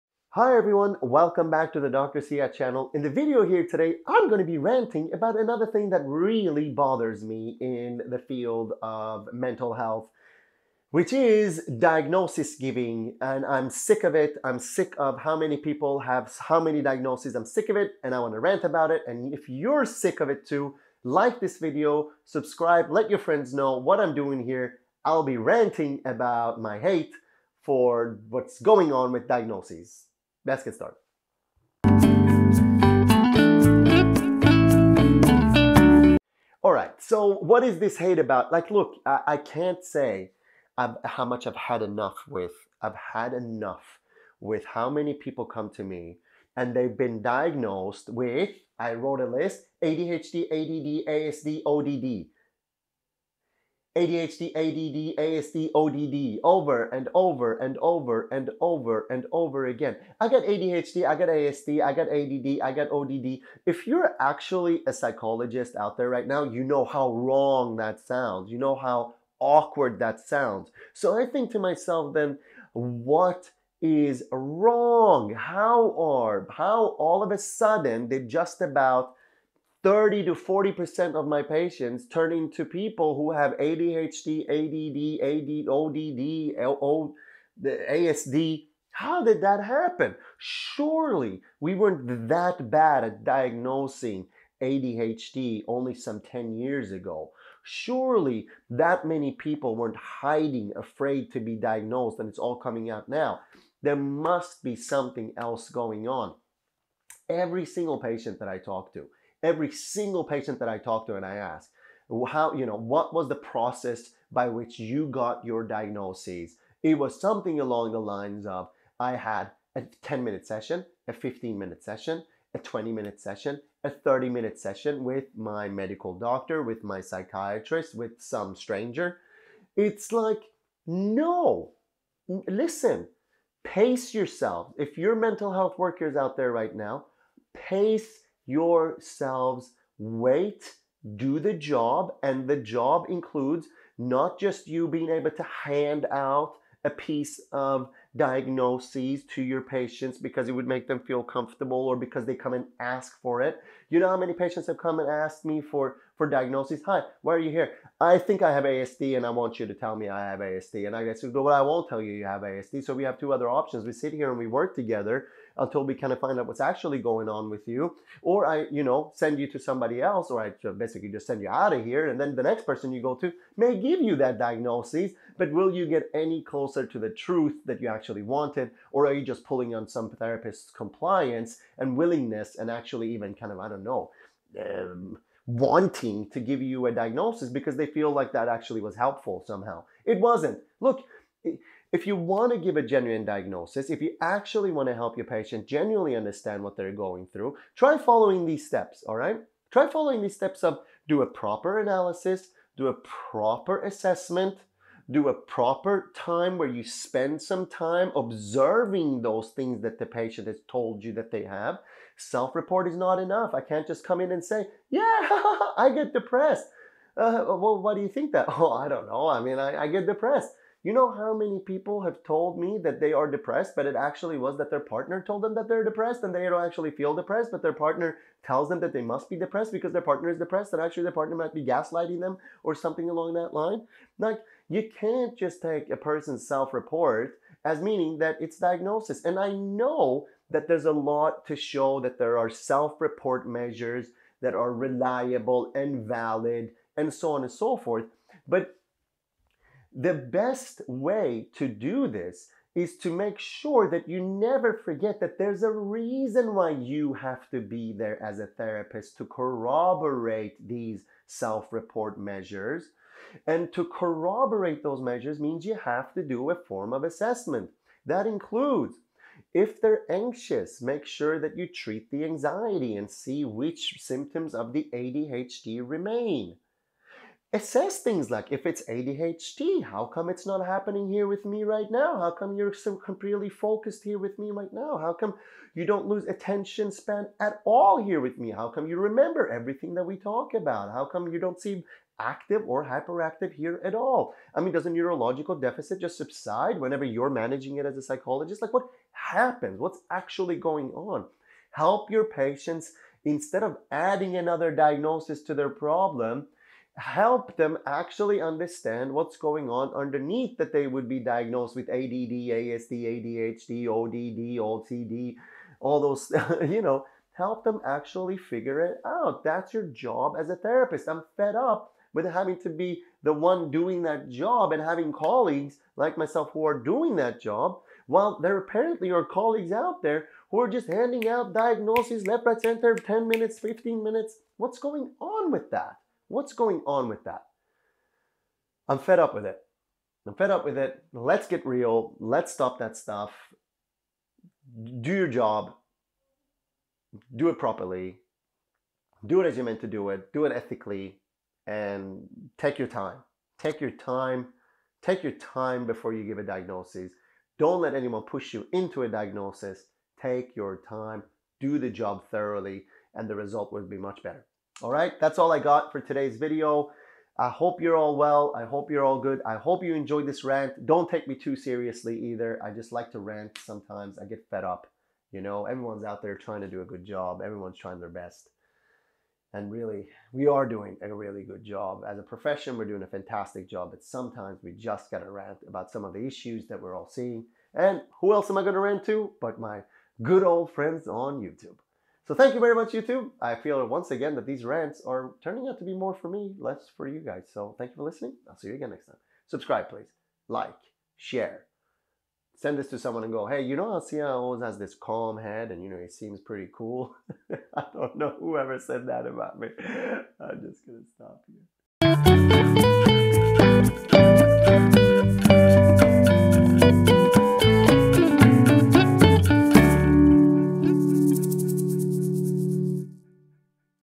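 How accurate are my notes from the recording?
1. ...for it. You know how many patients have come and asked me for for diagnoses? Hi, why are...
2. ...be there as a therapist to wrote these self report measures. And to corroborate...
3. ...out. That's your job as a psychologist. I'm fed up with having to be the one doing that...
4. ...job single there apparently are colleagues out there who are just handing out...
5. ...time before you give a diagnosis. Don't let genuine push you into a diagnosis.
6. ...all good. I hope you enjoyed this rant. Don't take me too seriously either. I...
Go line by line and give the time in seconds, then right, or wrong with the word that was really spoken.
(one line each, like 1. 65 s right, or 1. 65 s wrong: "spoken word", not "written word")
1. 153 s right
2. 257 s wrong: "corroborate", not "wrote"
3. 319 s wrong: "therapist", not "psychologist"
4. 327 s wrong: "while", not "single"
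5. 355 s wrong: "anyone", not "genuine"
6. 369 s right.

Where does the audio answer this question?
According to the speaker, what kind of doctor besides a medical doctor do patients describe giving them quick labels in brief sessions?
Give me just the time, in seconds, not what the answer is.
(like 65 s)
127 s.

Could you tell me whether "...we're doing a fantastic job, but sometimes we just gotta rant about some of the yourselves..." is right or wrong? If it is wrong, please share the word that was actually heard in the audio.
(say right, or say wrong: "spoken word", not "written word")
wrong: "issues", not "yourselves".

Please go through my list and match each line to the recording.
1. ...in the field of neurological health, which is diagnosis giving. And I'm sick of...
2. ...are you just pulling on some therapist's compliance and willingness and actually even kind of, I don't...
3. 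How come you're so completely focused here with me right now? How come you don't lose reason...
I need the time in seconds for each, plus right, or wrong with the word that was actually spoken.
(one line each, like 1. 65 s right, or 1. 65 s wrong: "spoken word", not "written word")
1. 7 s wrong: "mental", not "neurological"
2. 179 s right
3. 282 s wrong: "attention", not "reason".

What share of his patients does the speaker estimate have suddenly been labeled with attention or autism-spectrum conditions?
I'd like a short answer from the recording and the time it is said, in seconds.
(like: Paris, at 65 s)
30 to 40%, at 79 s.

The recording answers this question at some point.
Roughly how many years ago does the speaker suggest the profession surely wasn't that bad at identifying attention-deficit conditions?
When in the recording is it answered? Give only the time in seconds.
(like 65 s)
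96 s.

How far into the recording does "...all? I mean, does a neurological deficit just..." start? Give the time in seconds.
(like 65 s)
293 s.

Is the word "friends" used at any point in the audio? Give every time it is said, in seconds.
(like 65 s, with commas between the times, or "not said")
23 s, 390 s.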